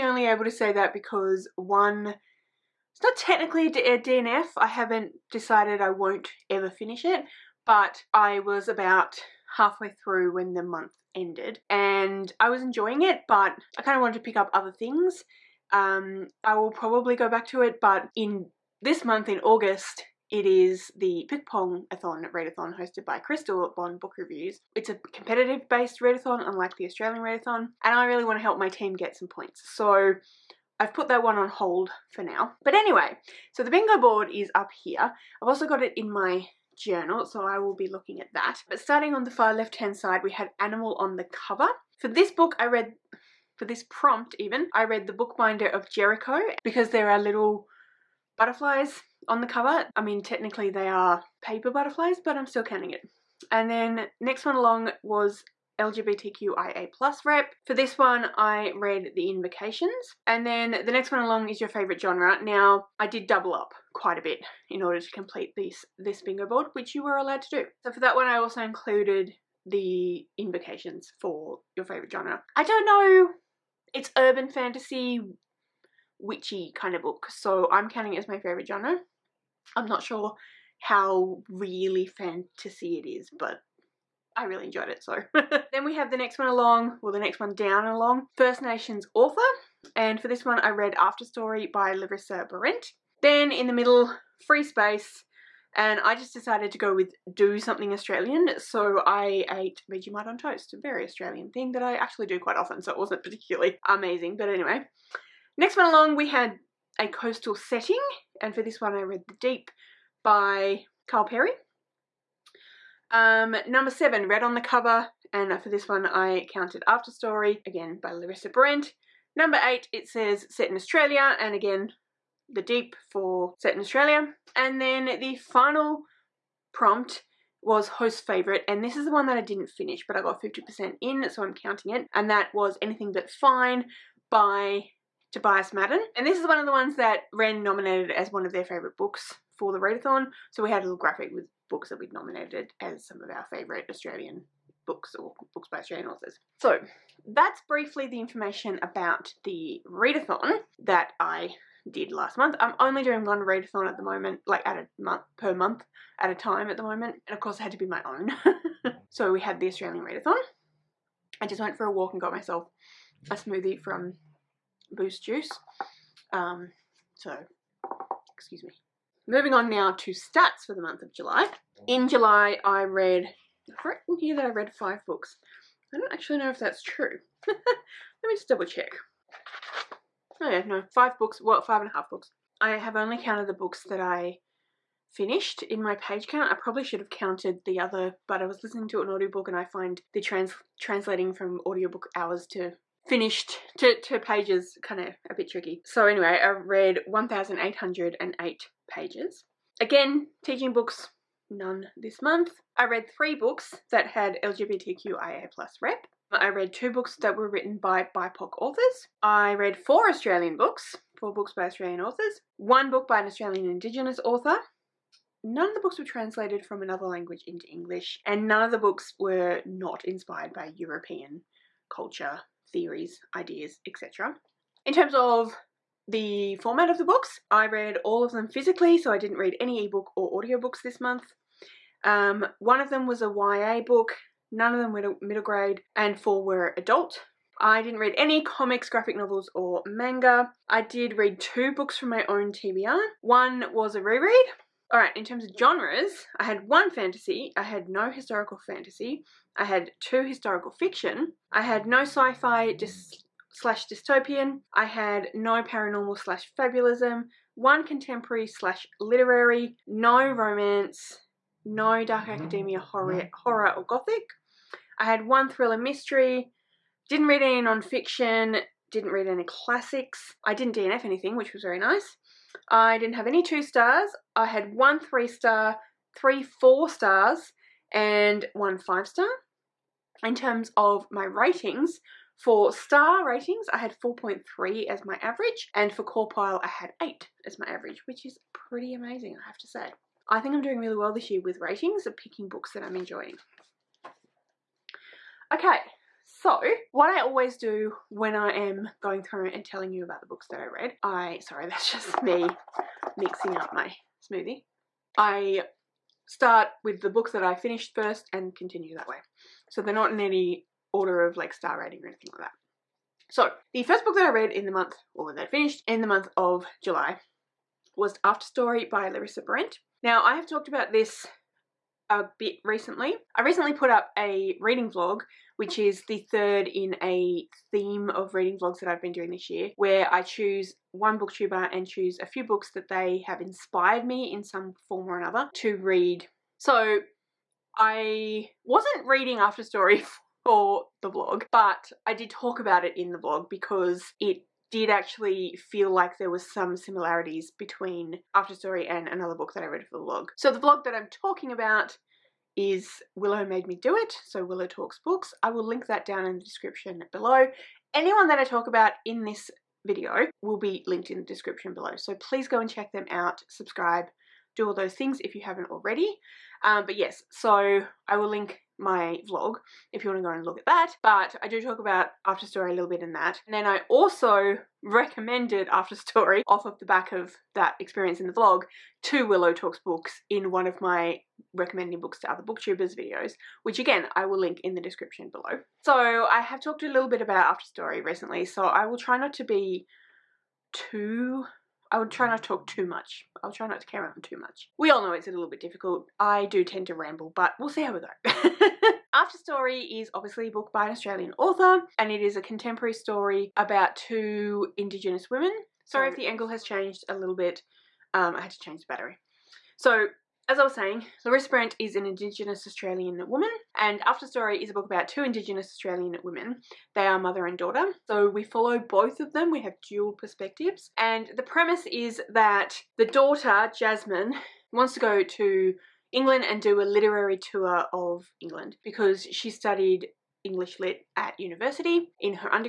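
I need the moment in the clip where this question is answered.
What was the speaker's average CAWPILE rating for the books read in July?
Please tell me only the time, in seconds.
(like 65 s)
287 s.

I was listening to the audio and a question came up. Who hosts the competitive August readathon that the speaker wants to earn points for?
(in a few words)
Crystal.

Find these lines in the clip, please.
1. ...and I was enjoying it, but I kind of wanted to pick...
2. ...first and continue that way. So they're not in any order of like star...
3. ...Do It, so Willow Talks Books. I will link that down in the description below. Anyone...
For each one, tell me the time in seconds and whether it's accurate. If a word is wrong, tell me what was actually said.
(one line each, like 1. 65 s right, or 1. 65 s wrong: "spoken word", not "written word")
1. 11 s right
2. 307 s right
3. 353 s right.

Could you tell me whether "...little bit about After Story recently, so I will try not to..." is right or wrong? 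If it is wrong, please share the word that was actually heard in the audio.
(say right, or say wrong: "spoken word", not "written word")
right.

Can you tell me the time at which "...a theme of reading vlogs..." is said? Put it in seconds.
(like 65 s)
327 s.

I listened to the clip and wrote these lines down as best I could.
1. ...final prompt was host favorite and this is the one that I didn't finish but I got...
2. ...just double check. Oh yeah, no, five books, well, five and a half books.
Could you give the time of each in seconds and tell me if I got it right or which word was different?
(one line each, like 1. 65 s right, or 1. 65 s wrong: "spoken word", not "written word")
1. 125 s right
2. 178 s right.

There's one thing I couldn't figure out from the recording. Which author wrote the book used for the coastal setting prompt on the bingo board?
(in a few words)
Kyle Perry.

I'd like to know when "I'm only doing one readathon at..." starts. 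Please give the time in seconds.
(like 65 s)
152 s.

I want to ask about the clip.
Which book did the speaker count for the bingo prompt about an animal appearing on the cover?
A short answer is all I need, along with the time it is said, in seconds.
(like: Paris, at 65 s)
The Bookbinder of Jericho, at 45 s.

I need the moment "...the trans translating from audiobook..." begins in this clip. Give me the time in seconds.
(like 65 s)
190 s.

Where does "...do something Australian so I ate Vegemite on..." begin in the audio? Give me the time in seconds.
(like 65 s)
97 s.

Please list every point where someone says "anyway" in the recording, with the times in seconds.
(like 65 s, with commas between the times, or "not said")
32 s, 104 s, 196 s.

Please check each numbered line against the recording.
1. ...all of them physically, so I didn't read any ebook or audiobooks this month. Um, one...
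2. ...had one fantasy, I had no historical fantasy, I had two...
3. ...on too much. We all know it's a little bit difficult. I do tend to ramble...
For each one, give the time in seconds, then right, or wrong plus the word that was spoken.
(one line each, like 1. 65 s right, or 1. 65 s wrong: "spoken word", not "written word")
1. 228 s right
2. 246 s right
3. 394 s right.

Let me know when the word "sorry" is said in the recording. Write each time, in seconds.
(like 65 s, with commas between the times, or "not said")
301 s, 405 s.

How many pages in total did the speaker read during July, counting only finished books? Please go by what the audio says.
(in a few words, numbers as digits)
1,808.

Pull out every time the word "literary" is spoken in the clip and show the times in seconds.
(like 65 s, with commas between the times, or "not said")
258 s, 426 s.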